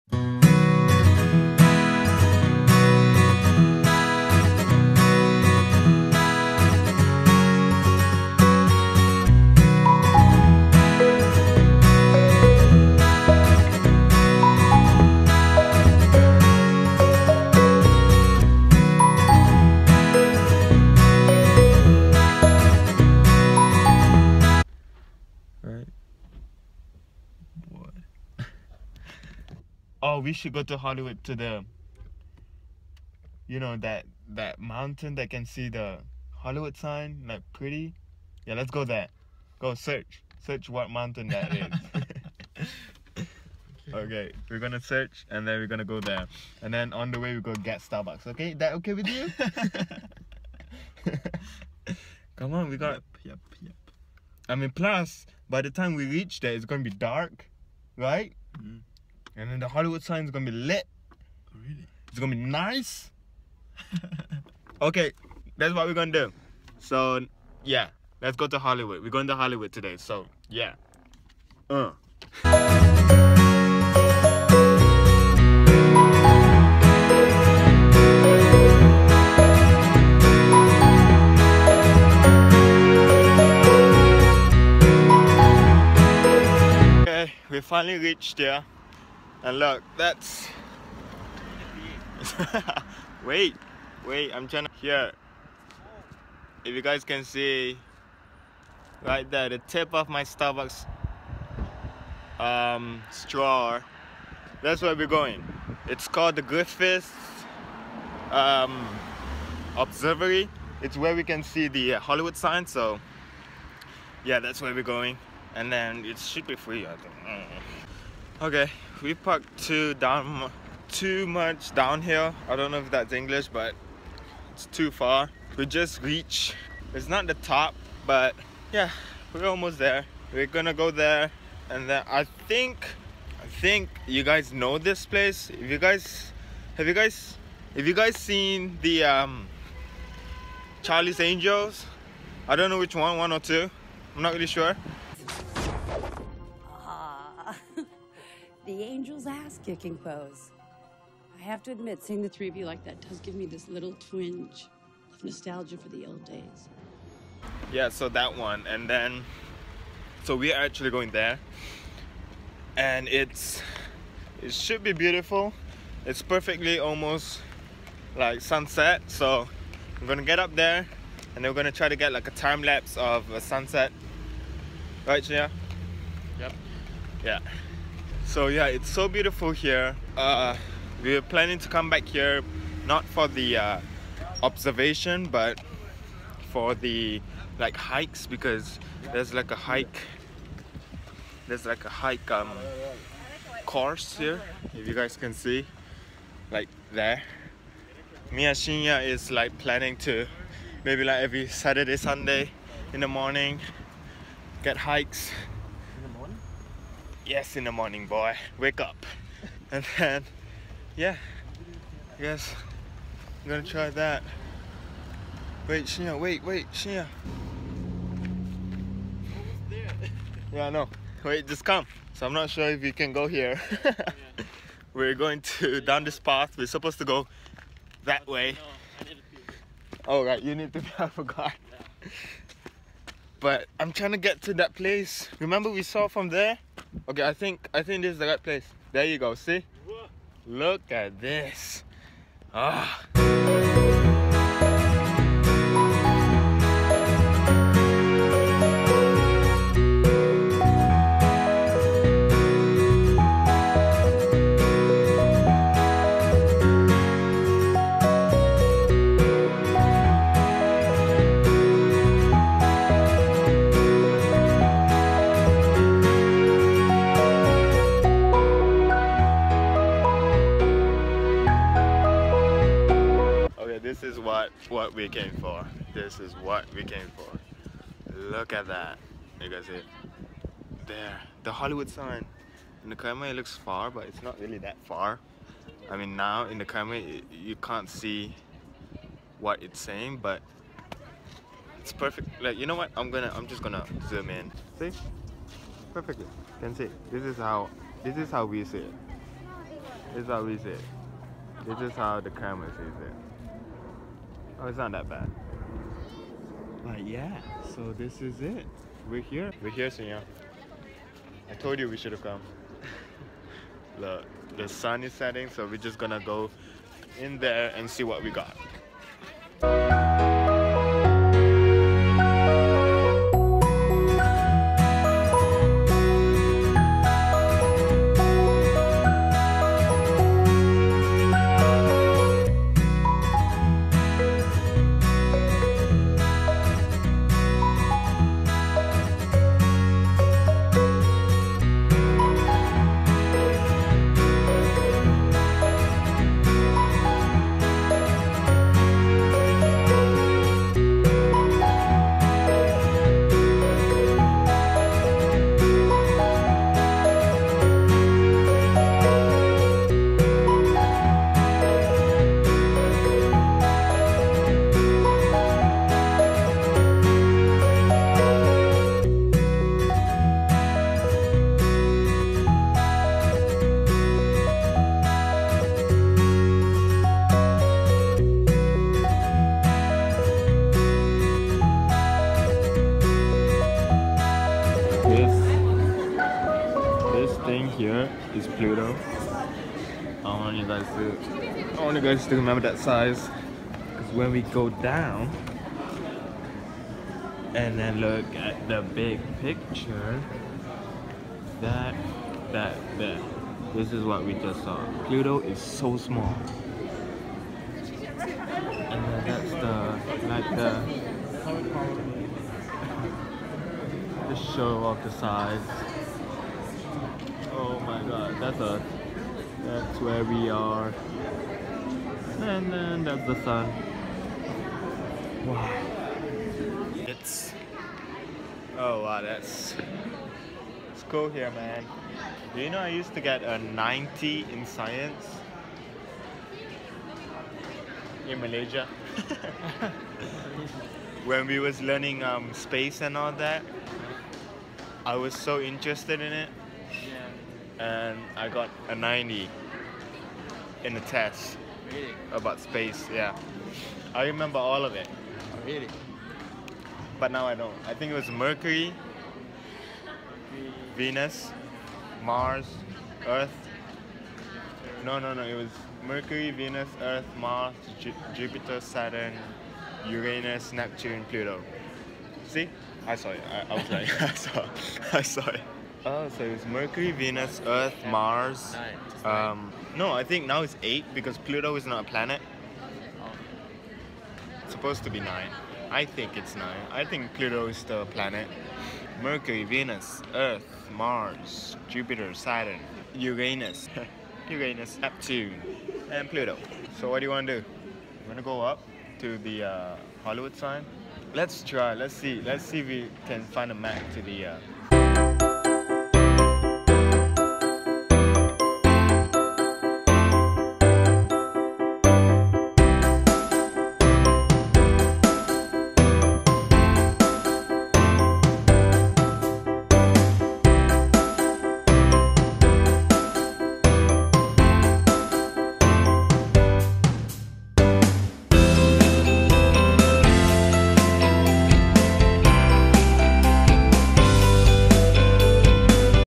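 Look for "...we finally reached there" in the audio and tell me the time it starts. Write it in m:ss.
1:27.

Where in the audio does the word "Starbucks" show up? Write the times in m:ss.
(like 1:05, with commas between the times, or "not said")
0:47, 1:40.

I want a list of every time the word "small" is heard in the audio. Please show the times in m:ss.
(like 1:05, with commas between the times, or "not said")
6:45.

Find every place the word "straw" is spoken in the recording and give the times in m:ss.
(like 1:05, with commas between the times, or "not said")
1:43.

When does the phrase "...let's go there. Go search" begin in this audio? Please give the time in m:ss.
0:38.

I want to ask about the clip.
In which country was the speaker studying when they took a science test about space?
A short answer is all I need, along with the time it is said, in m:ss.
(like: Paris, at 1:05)
Malaysia, at 7:18.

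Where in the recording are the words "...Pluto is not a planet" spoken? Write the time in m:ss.
8:01.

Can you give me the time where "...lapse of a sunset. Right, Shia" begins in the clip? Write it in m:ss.
2:52.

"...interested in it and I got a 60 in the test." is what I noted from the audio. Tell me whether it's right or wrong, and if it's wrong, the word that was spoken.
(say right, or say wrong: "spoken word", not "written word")
wrong: "90", not "60".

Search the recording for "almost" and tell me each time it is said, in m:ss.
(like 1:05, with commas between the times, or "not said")
2:09, 2:46.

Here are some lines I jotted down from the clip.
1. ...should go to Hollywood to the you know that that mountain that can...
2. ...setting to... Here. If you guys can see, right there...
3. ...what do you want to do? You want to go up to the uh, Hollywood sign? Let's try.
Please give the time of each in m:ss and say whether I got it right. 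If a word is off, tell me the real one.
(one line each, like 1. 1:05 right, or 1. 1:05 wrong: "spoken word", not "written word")
1. 0:30 right
2. 1:34 wrong: "trying", not "setting"
3. 8:17 right.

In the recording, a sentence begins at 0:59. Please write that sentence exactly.
And then the Hollywood sign is gonna be lit.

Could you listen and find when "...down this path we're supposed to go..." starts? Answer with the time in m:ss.
3:45.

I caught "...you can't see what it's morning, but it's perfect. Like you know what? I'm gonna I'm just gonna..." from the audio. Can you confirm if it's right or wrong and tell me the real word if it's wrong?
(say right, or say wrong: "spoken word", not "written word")
wrong: "saying", not "morning".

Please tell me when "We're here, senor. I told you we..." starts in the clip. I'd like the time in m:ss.
5:09.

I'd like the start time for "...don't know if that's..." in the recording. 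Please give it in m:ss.
2:02.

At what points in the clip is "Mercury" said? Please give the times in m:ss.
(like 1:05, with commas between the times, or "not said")
7:38, 7:46, 7:56, 8:09.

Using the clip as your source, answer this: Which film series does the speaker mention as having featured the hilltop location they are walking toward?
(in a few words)
Charlie's Angels.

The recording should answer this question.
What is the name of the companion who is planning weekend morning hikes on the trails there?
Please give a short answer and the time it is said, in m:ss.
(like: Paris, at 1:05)
Mia Shinya, at 3:18.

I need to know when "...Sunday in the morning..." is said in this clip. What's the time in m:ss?
3:21.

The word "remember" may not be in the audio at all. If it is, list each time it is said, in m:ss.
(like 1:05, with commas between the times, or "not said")
3:55, 6:32, 7:34.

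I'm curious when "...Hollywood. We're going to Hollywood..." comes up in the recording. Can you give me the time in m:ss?
1:08.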